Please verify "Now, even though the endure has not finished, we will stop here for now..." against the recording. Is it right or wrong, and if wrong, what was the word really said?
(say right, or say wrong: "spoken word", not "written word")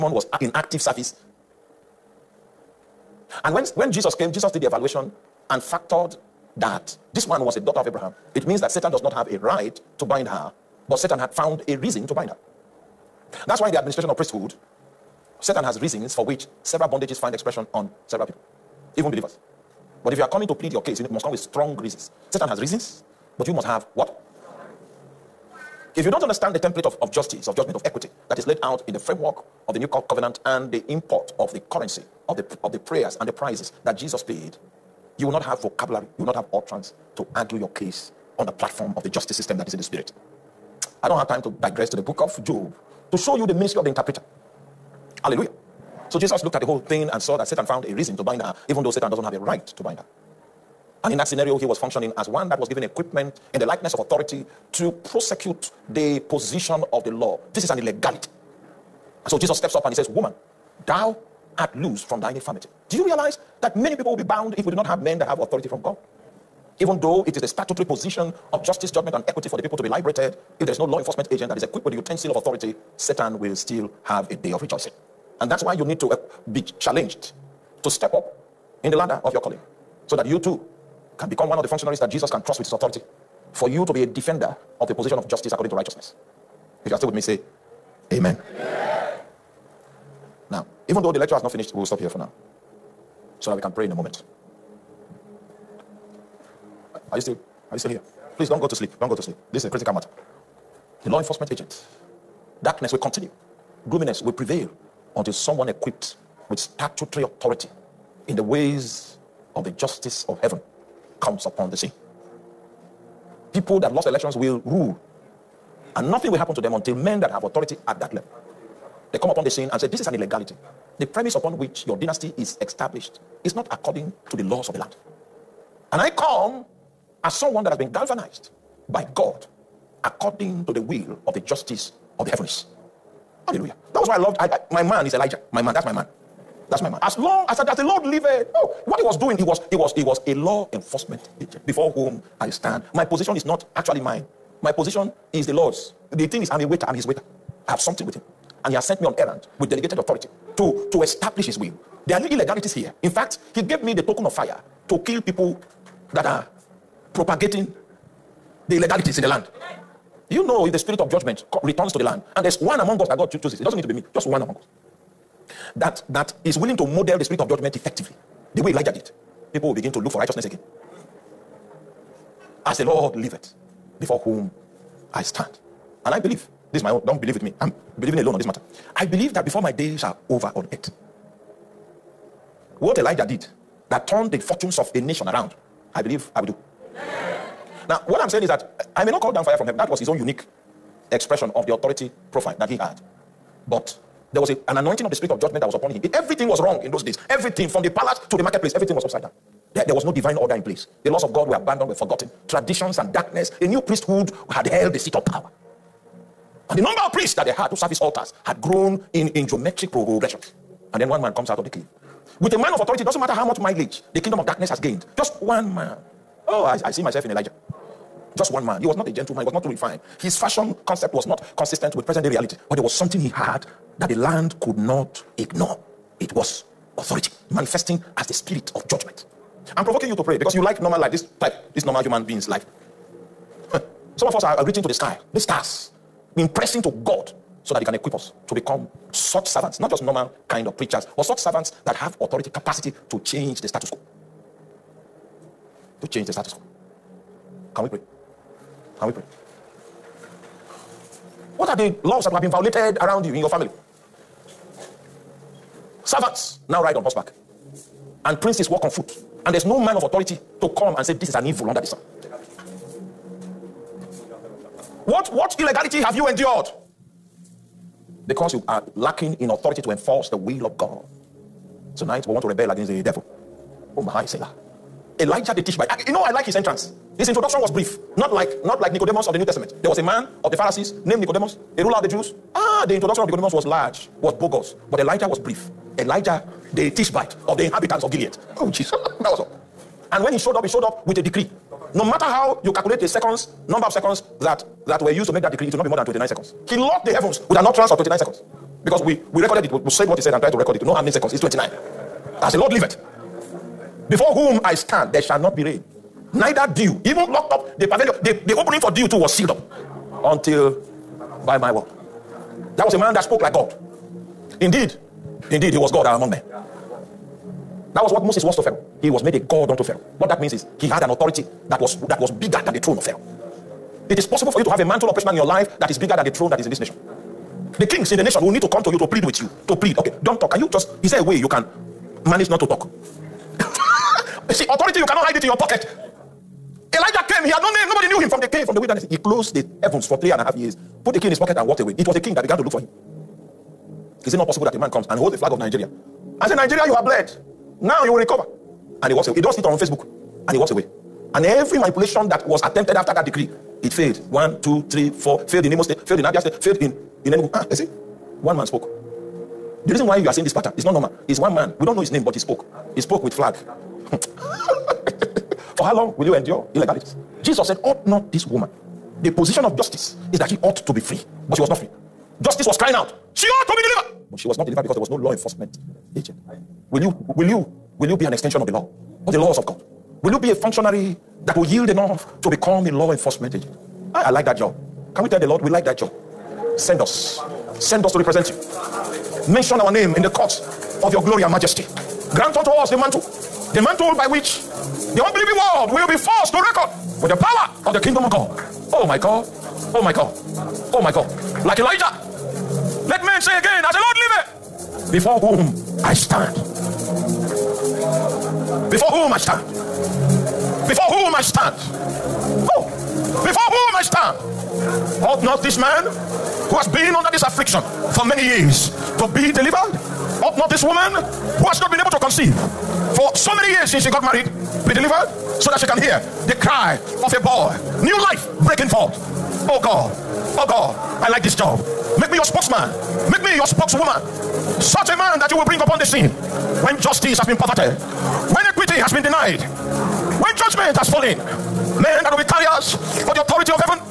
wrong: "lecture", not "endure".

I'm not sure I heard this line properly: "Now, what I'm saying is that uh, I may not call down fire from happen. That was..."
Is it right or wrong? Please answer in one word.
wrong.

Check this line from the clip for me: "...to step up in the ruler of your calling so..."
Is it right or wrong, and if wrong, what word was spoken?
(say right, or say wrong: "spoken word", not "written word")
wrong: "ladder", not "ruler".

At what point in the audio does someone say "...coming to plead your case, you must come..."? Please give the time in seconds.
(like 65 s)
20 s.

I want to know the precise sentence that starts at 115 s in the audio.
And nothing will happen to them until men that have authority at that level.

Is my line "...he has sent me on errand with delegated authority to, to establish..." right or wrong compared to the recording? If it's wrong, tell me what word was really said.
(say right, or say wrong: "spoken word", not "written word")
right.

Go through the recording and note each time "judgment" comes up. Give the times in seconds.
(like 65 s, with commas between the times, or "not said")
27 s, 68 s, 161 s, 167 s, 195 s, 228 s, 440 s.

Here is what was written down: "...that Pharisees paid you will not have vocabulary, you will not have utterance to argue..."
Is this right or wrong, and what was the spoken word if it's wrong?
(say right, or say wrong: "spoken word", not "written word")
wrong: "Jesus", not "Pharisees".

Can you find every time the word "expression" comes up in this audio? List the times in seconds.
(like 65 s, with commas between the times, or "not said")
17 s, 191 s.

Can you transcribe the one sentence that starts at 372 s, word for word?
Justice was crying out, She ought to be delivered, but she was not delivered because there was no law enforcement agent.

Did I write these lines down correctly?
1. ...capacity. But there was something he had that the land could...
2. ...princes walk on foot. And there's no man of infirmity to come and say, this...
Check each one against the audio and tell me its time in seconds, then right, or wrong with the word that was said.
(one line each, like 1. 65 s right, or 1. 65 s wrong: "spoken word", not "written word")
1. 222 s wrong: "reality", not "capacity"
2. 258 s wrong: "authority", not "infirmity".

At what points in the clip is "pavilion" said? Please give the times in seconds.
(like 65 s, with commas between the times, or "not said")
307 s.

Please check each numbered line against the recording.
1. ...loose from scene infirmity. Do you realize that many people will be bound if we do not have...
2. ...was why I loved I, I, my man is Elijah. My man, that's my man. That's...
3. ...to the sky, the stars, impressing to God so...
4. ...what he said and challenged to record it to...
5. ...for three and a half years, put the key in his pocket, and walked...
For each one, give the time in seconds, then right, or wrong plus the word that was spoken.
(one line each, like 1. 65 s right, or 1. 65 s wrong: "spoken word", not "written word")
1. 61 s wrong: "thine", not "scene"
2. 134 s right
3. 234 s right
4. 300 s wrong: "tried", not "challenged"
5. 340 s right.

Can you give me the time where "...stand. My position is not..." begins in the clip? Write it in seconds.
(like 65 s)
142 s.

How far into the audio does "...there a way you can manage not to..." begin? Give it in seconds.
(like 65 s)
331 s.